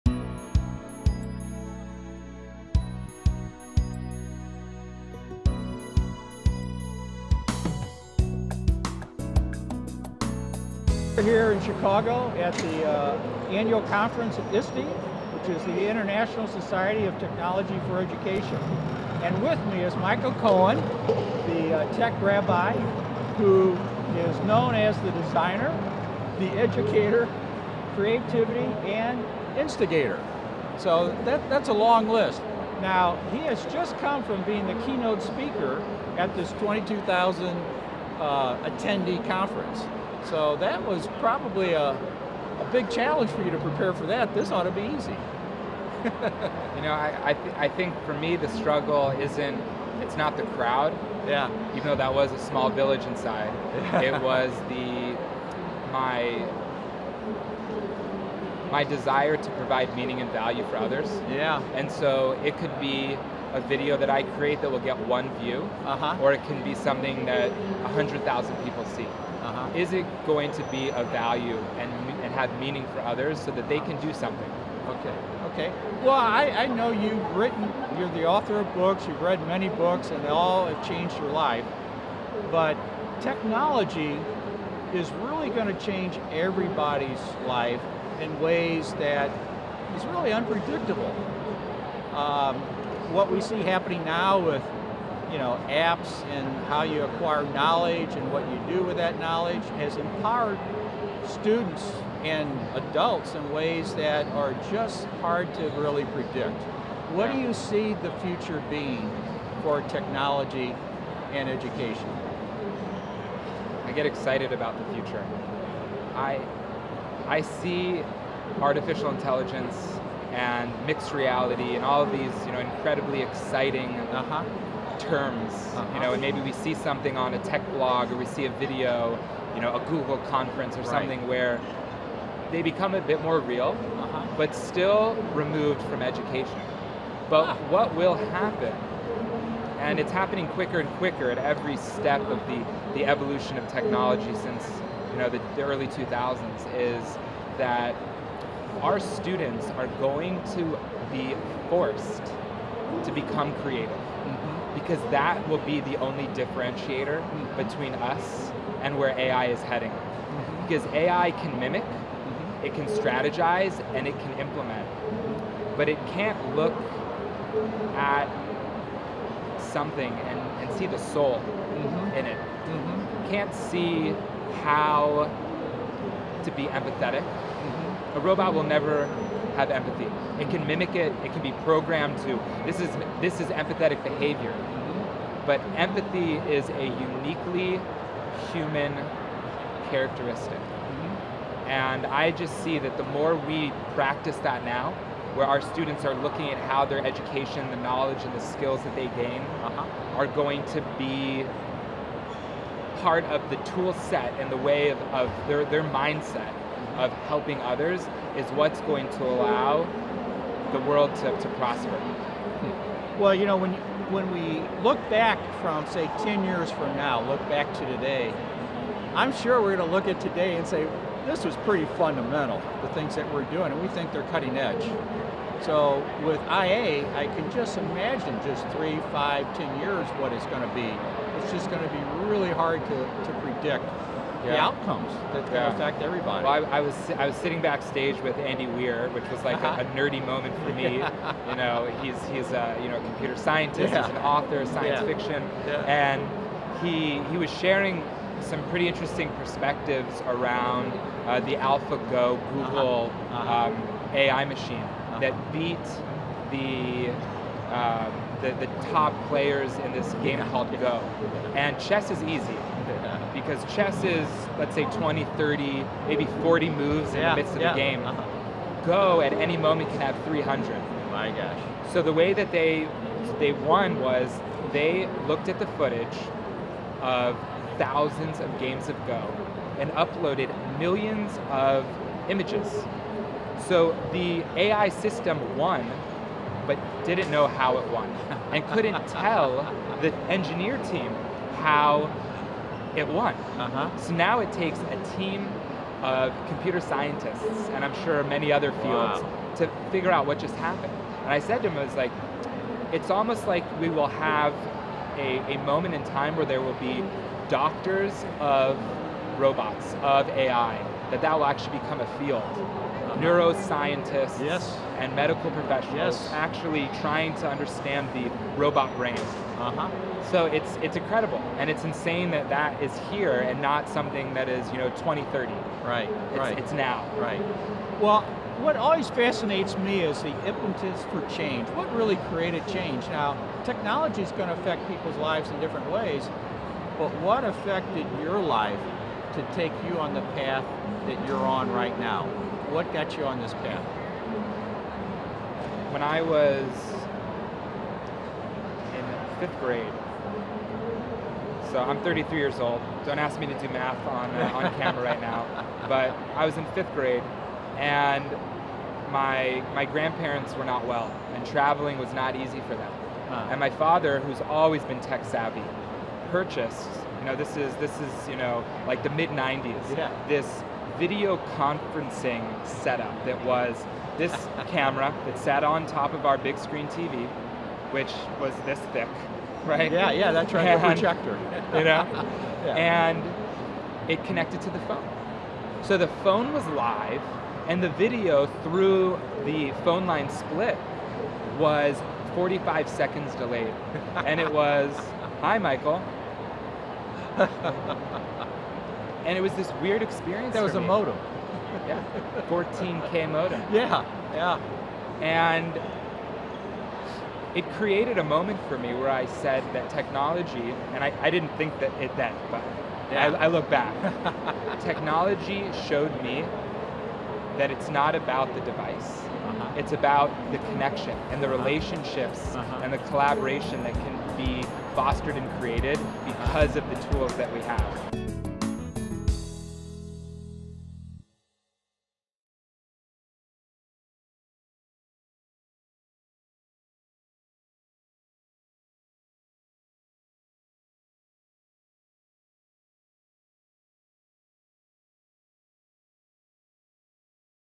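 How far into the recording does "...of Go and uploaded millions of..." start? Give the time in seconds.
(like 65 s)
278 s.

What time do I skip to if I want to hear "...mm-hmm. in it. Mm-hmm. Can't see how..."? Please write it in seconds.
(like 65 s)
171 s.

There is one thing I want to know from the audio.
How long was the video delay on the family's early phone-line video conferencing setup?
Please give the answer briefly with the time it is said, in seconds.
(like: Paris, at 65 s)
45 seconds, at 392 s.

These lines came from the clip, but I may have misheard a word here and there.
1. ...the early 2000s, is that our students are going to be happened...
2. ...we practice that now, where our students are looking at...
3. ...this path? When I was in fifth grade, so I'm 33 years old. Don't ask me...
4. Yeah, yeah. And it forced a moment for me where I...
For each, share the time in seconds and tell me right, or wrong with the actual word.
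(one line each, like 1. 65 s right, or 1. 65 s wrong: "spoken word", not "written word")
1. 145 s wrong: "forced", not "happened"
2. 193 s right
3. 343 s right
4. 403 s wrong: "created", not "forced".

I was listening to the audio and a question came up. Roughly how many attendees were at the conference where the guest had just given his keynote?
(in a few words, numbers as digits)
22,000.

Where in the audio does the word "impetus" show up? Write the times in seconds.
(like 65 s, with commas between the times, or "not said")
330 s.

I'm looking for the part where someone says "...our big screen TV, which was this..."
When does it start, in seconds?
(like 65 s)
376 s.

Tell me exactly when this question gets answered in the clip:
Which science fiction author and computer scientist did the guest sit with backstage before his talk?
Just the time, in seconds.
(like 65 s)
238 s.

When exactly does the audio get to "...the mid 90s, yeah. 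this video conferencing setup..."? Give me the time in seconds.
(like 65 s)
369 s.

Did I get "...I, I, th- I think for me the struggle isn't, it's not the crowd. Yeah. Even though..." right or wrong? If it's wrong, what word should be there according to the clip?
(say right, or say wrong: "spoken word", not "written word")
right.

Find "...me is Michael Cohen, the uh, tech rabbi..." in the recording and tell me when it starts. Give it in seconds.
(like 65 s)
19 s.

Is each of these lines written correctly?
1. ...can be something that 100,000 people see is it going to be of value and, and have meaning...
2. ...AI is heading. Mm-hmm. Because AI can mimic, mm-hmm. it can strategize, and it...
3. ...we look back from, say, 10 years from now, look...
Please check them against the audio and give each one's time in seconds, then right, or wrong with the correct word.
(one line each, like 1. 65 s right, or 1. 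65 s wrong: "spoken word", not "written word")
1. 66 s right
2. 159 s right
3. 214 s right.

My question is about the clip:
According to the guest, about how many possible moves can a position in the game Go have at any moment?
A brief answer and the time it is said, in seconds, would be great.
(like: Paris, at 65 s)
300, at 270 s.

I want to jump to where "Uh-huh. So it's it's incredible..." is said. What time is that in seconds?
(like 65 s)
319 s.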